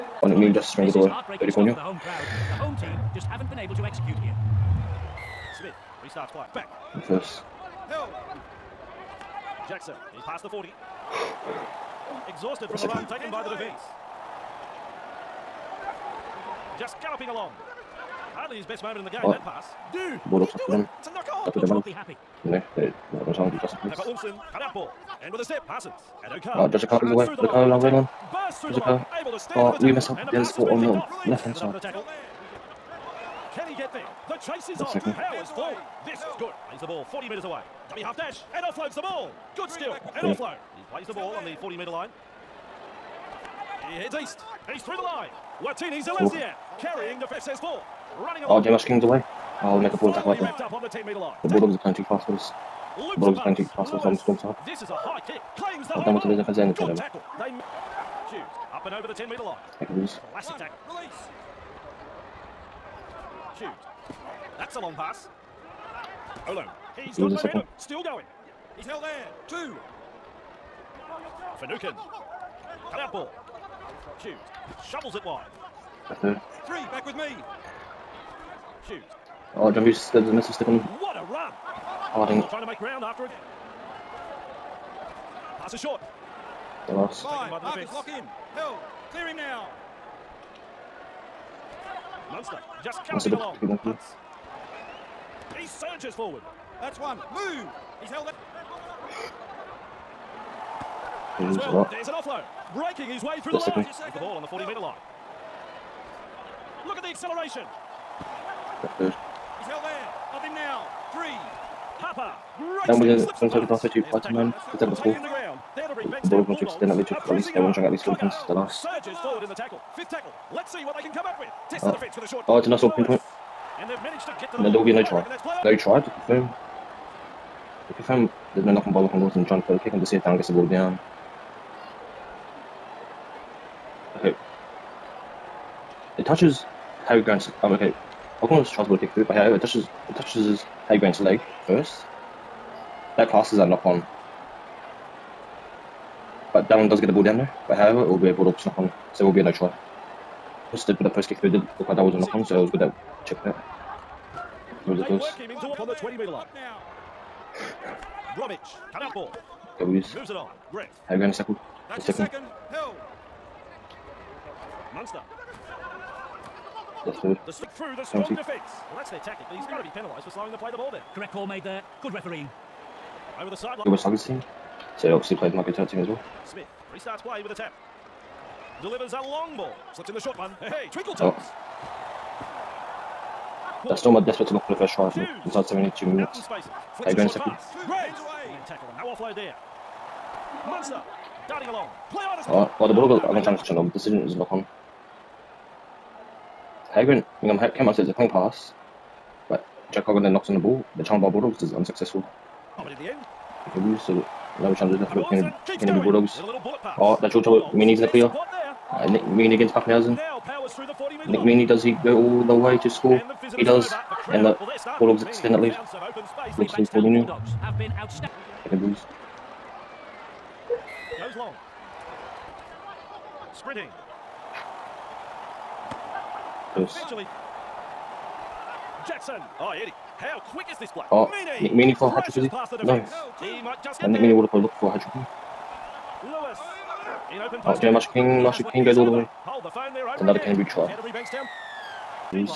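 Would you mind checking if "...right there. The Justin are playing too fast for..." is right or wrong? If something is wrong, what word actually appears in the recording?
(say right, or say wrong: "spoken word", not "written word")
wrong: "Bulldogs", not "Justin".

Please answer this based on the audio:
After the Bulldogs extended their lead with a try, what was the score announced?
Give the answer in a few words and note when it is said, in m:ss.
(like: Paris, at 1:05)
4-0, at 3:36.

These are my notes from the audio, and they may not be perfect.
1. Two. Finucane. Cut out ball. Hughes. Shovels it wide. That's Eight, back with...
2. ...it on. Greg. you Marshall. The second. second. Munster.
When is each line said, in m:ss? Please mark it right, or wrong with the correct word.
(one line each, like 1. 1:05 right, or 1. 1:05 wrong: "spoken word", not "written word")
1. 1:09 wrong: "Three", not "Eight"
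2. 2:40 wrong: "Saku", not "Marshall".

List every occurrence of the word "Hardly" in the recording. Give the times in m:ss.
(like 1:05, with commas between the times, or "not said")
0:18.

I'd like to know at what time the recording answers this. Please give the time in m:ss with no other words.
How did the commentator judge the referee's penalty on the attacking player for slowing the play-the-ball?
2:51.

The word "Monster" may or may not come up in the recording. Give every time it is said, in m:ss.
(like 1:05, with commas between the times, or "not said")
3:10.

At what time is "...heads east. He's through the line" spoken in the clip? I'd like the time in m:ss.
0:43.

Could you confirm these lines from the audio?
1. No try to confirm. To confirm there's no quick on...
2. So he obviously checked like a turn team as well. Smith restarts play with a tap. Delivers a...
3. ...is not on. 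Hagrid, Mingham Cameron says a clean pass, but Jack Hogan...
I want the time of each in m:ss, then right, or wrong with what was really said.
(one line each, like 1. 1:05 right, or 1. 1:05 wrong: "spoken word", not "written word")
1. 2:05 wrong: "knock", not "quick"
2. 2:54 wrong: "played", not "checked"
3. 3:14 right.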